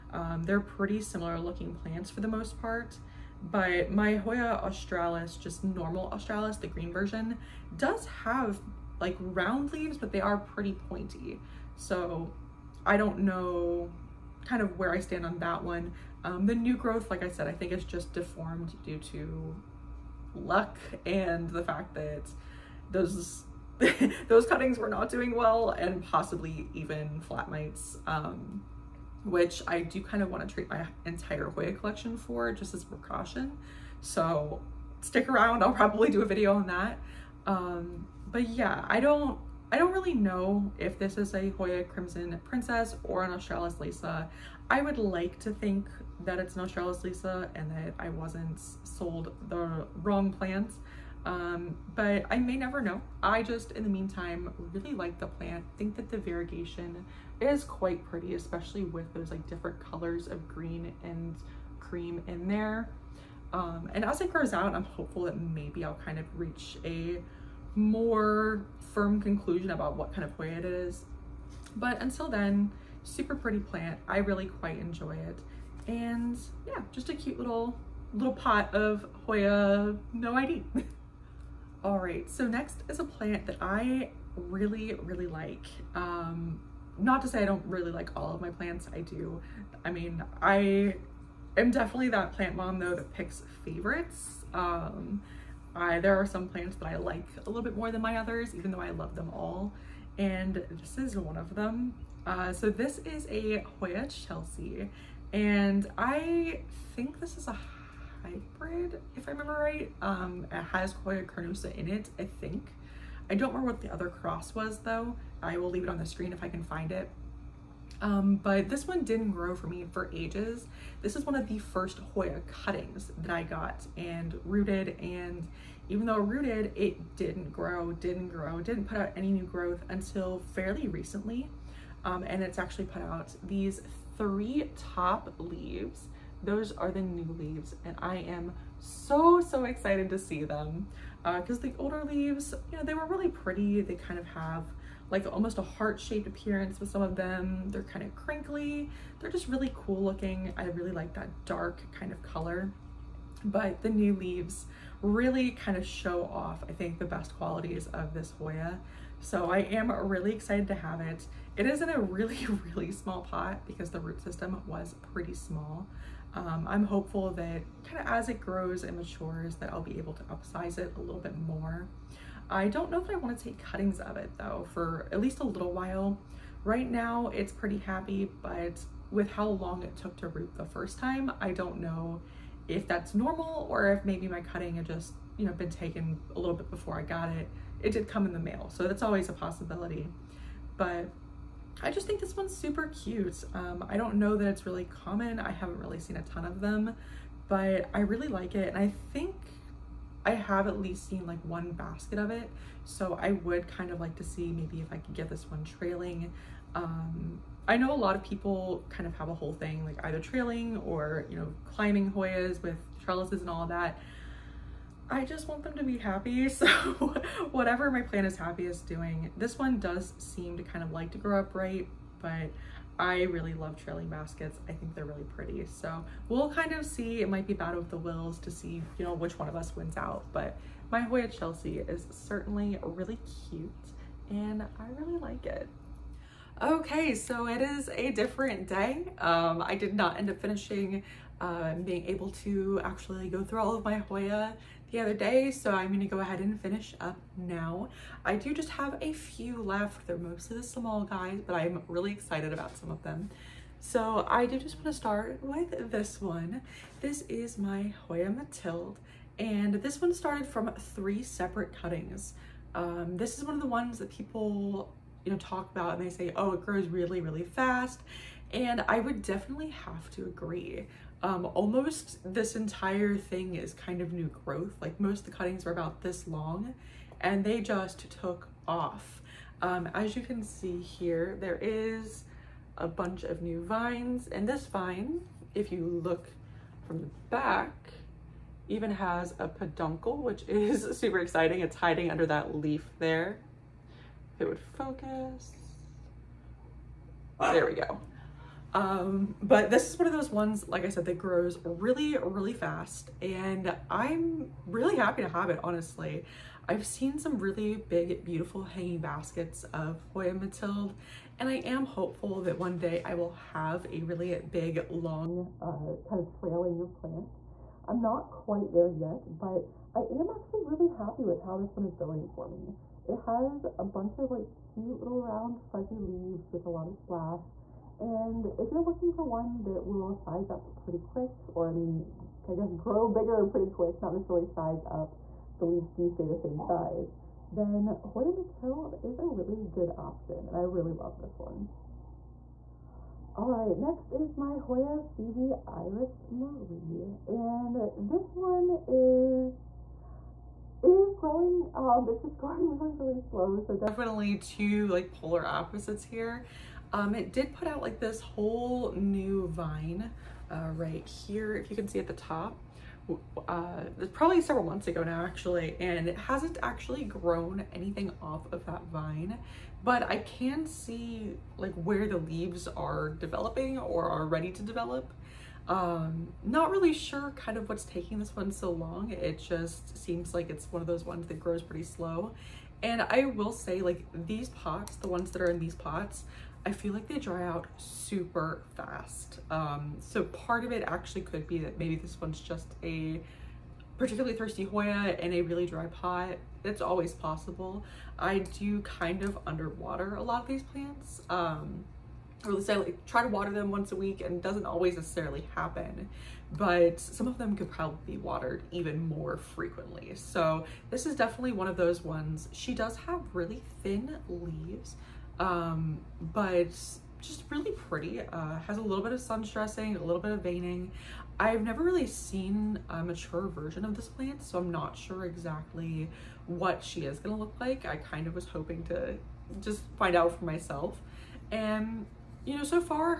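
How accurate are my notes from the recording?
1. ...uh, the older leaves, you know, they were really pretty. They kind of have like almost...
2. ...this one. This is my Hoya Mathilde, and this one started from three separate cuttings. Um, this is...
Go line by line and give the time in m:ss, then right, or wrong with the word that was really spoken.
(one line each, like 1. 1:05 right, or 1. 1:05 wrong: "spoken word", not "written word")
1. 2:21 right
2. 4:15 right.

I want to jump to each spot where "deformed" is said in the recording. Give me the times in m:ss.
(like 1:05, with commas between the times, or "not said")
0:18.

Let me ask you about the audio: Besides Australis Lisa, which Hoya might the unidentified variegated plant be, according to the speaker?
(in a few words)
Crimson Princess.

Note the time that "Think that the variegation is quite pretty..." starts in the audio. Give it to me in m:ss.
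0:55.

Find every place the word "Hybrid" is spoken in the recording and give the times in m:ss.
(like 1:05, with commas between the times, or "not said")
1:48.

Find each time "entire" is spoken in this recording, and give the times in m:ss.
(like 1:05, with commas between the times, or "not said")
0:31, 4:32.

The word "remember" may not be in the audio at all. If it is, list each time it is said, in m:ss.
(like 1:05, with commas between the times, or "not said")
1:49, 1:53.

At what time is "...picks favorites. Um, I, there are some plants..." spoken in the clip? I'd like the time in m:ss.
1:33.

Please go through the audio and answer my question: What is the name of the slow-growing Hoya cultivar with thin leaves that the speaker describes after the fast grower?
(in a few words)
Iris Marie.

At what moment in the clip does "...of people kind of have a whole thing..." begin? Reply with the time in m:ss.
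3:28.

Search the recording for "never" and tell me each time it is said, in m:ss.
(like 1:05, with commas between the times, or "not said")
0:52, 7:01.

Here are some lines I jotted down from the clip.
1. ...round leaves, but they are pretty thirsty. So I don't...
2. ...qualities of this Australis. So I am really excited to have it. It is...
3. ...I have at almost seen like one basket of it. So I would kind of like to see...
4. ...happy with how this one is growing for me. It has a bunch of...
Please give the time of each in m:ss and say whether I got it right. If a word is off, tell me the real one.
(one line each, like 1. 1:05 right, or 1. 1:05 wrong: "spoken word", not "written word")
1. 0:09 wrong: "pointy", not "thirsty"
2. 2:37 wrong: "Hoya", not "Australis"
3. 3:20 wrong: "least", not "almost"
4. 5:20 right.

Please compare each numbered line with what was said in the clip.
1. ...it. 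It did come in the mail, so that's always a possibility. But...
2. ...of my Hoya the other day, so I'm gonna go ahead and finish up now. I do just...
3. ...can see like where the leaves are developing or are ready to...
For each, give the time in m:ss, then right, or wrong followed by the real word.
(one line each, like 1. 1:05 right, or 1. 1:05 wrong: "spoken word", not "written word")
1. 3:07 right
2. 4:03 right
3. 6:10 right.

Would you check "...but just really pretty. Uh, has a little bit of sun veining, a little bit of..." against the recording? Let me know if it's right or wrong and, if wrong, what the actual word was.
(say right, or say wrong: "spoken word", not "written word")
wrong: "stressing", not "veining".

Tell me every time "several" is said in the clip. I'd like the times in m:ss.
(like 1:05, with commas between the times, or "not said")
6:04.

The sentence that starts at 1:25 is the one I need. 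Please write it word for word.
Um, not to say I don't really like all of my plants, I do.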